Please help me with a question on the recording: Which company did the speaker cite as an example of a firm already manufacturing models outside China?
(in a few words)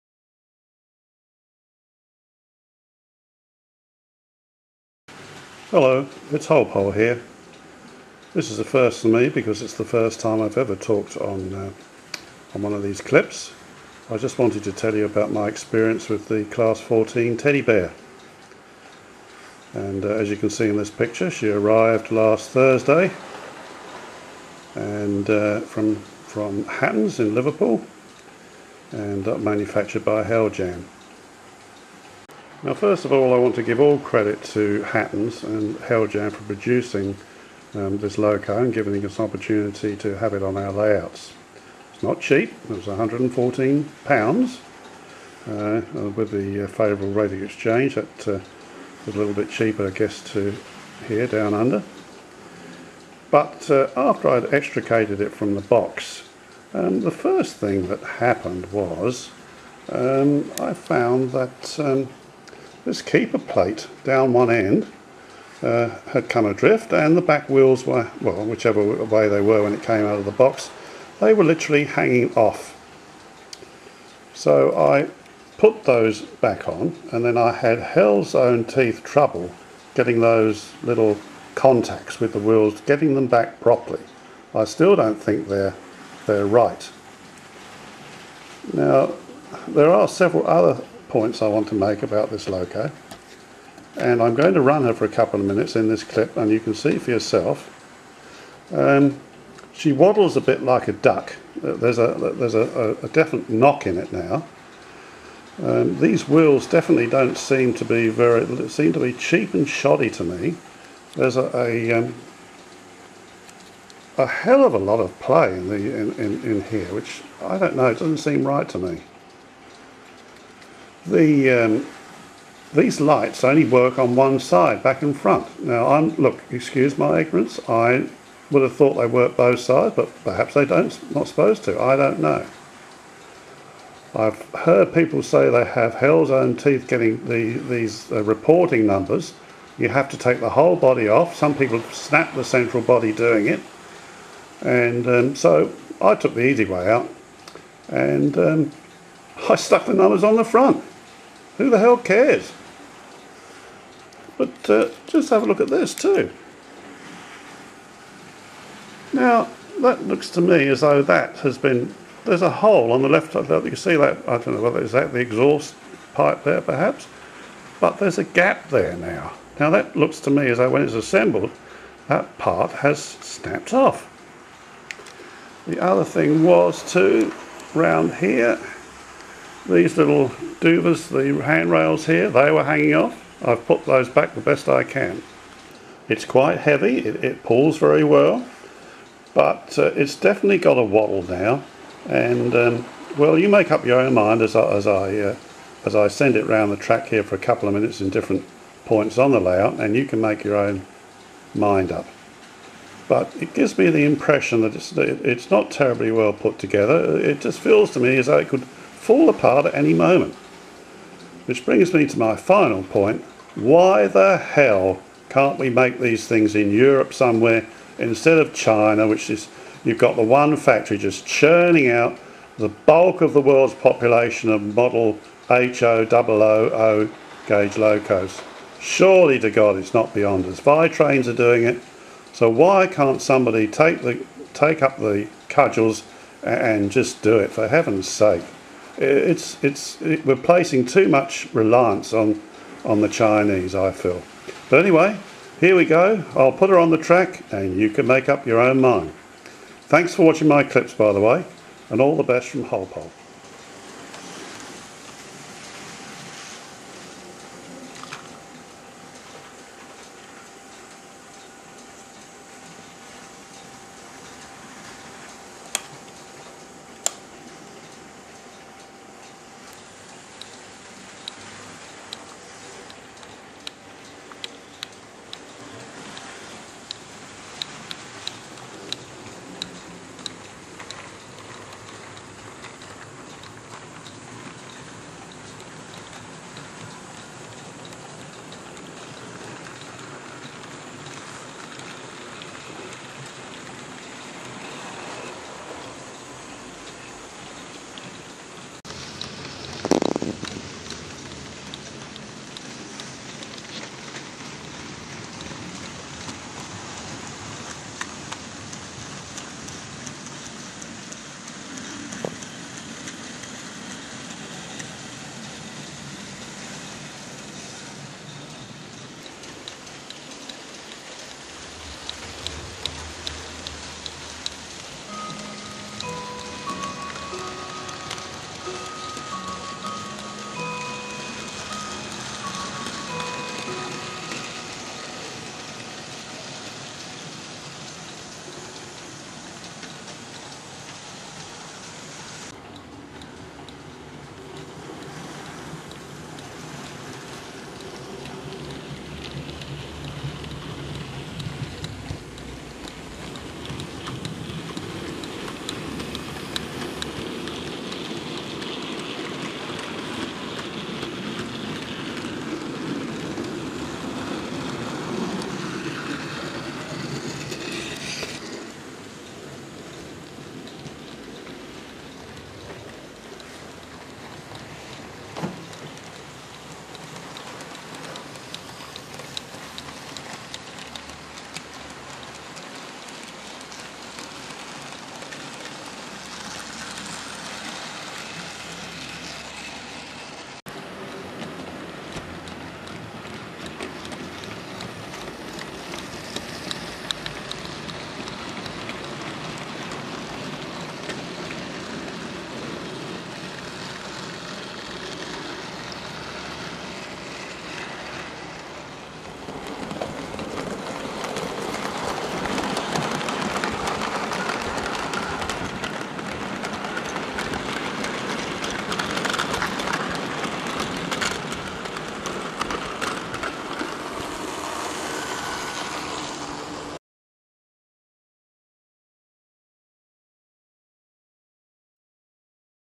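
Vitrains.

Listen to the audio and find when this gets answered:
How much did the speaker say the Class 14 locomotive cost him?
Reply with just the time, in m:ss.
0:42.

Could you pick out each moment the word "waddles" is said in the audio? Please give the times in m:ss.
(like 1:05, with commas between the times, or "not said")
1:39, 3:10.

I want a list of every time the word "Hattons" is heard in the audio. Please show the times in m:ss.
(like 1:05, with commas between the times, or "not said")
0:26, 0:34.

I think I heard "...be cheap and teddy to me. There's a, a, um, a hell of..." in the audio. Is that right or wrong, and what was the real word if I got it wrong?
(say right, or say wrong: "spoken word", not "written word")
wrong: "shoddy", not "teddy".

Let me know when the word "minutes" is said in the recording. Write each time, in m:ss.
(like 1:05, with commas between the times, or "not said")
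1:35, 3:17.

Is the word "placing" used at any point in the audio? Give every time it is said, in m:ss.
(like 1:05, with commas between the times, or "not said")
4:00.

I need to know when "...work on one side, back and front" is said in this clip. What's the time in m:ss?
2:03.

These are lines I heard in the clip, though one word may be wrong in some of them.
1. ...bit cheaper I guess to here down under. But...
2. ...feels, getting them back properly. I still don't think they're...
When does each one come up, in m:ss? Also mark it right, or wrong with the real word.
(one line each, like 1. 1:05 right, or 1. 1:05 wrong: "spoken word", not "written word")
1. 0:49 right
2. 1:22 wrong: "wheels", not "feels".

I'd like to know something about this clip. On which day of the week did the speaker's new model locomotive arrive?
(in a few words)
Thursday.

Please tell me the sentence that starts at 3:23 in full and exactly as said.
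But it gives me the impression that it's, it's not terribly well put together.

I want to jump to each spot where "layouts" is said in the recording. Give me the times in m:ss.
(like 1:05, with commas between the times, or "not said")
0:40, 3:19.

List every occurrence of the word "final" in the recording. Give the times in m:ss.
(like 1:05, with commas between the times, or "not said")
3:32.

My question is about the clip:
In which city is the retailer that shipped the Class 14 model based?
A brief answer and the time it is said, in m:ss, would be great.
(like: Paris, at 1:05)
Liverpool, at 0:27.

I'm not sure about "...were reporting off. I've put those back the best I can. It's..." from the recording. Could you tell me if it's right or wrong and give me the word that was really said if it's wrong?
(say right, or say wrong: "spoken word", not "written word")
wrong: "hanging", not "reporting".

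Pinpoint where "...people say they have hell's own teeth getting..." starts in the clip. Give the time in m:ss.
2:14.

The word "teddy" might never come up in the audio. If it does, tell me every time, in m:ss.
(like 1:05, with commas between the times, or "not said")
0:17.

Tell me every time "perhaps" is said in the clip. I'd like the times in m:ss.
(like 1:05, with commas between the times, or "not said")
2:10, 2:46.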